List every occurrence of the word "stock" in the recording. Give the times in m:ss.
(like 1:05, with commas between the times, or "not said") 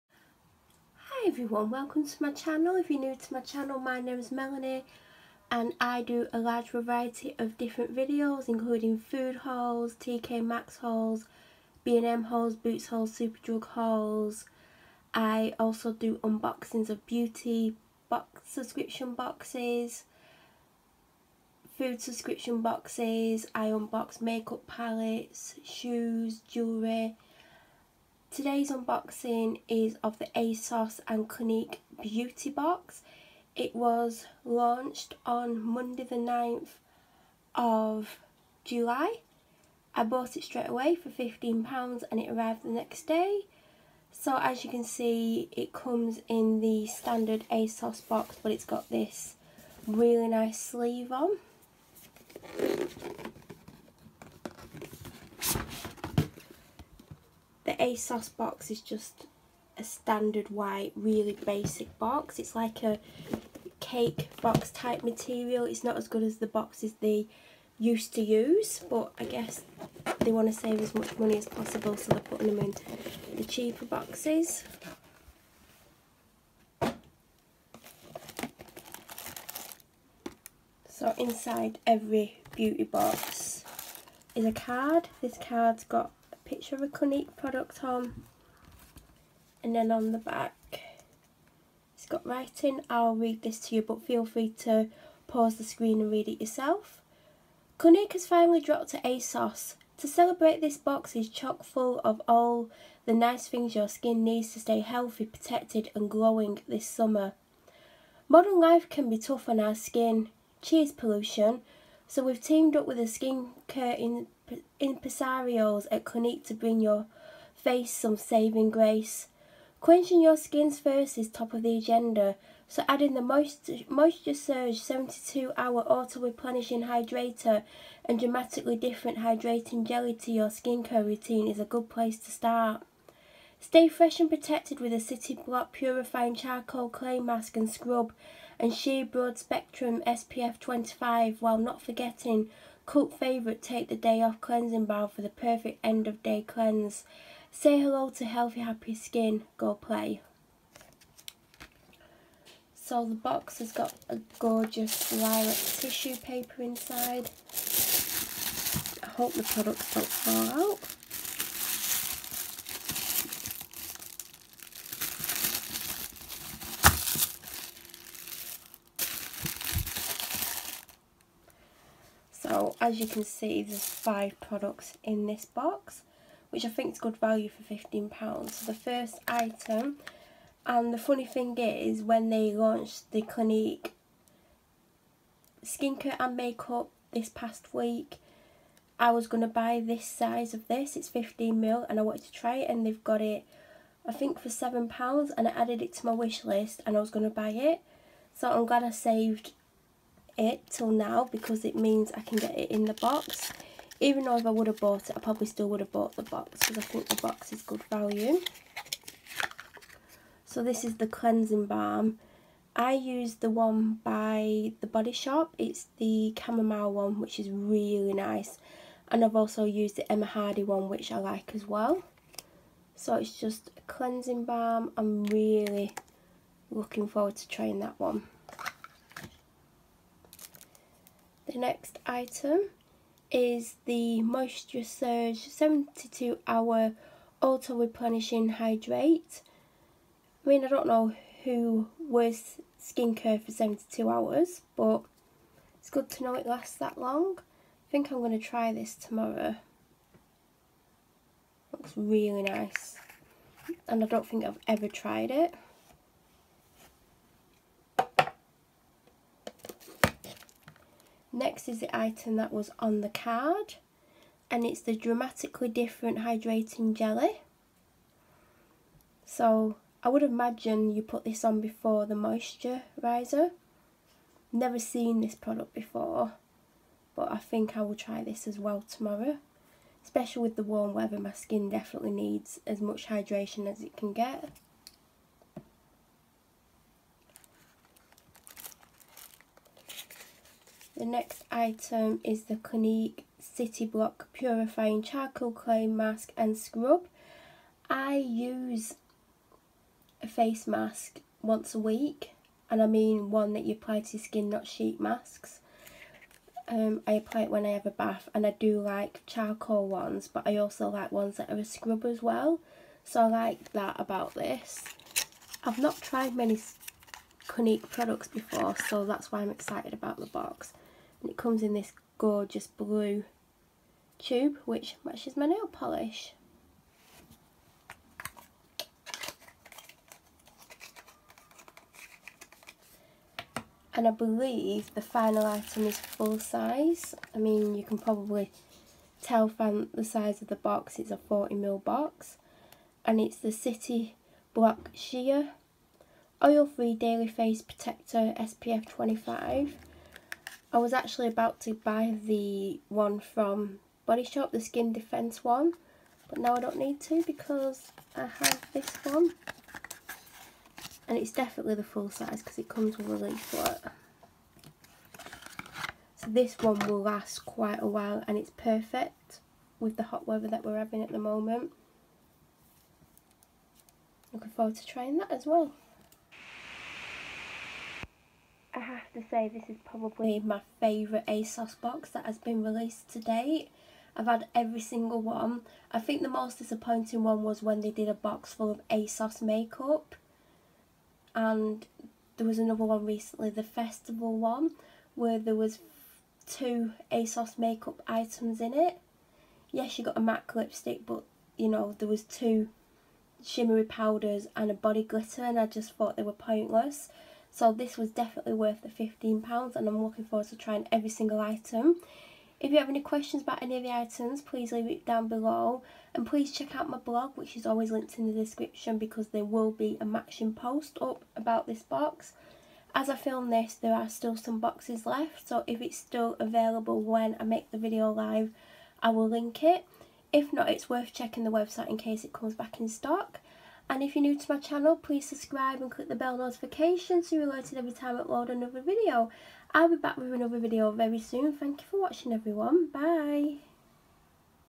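7:12.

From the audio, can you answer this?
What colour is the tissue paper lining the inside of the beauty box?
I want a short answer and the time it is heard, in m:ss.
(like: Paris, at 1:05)
Lilac, at 2:35.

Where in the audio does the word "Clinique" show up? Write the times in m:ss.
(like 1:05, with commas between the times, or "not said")
0:31, 1:26, 1:37, 1:56, 3:03, 4:52, 5:17.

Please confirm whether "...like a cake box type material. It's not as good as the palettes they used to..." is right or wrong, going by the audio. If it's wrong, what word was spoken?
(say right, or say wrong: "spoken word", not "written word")
wrong: "boxes", not "palettes".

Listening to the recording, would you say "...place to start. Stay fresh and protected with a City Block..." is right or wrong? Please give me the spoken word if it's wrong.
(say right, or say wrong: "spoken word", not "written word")
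right.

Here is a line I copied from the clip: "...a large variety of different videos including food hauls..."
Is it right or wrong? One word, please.
right.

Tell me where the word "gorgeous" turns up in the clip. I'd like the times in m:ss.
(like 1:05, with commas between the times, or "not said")
2:34, 5:22.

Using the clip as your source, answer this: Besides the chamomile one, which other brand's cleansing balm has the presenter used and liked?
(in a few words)
Emma Hardie.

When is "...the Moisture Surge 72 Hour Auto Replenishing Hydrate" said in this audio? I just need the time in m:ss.
3:53.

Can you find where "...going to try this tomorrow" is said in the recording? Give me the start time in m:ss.
4:08.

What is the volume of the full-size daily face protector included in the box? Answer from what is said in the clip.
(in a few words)
40ml.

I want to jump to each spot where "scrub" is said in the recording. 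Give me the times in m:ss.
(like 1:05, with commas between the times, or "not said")
2:17, 4:56, 5:11.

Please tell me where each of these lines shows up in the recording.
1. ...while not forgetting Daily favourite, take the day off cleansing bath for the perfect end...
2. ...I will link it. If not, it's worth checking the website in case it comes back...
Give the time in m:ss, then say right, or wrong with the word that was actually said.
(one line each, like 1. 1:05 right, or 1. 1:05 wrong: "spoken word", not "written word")
1. 2:21 wrong: "Cult", not "Daily"
2. 7:09 right.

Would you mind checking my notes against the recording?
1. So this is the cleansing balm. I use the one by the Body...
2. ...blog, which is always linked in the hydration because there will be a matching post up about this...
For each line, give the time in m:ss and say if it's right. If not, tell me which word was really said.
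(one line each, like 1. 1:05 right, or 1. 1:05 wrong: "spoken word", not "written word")
1. 3:30 right
2. 6:56 wrong: "description", not "hydration".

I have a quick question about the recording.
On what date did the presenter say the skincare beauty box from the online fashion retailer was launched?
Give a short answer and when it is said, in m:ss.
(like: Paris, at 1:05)
Monday 9th July, at 0:35.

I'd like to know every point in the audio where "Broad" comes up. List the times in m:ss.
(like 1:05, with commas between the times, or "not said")
2:19.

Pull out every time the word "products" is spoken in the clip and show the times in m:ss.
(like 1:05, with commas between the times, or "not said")
1:27, 2:39, 2:54, 4:35, 5:17.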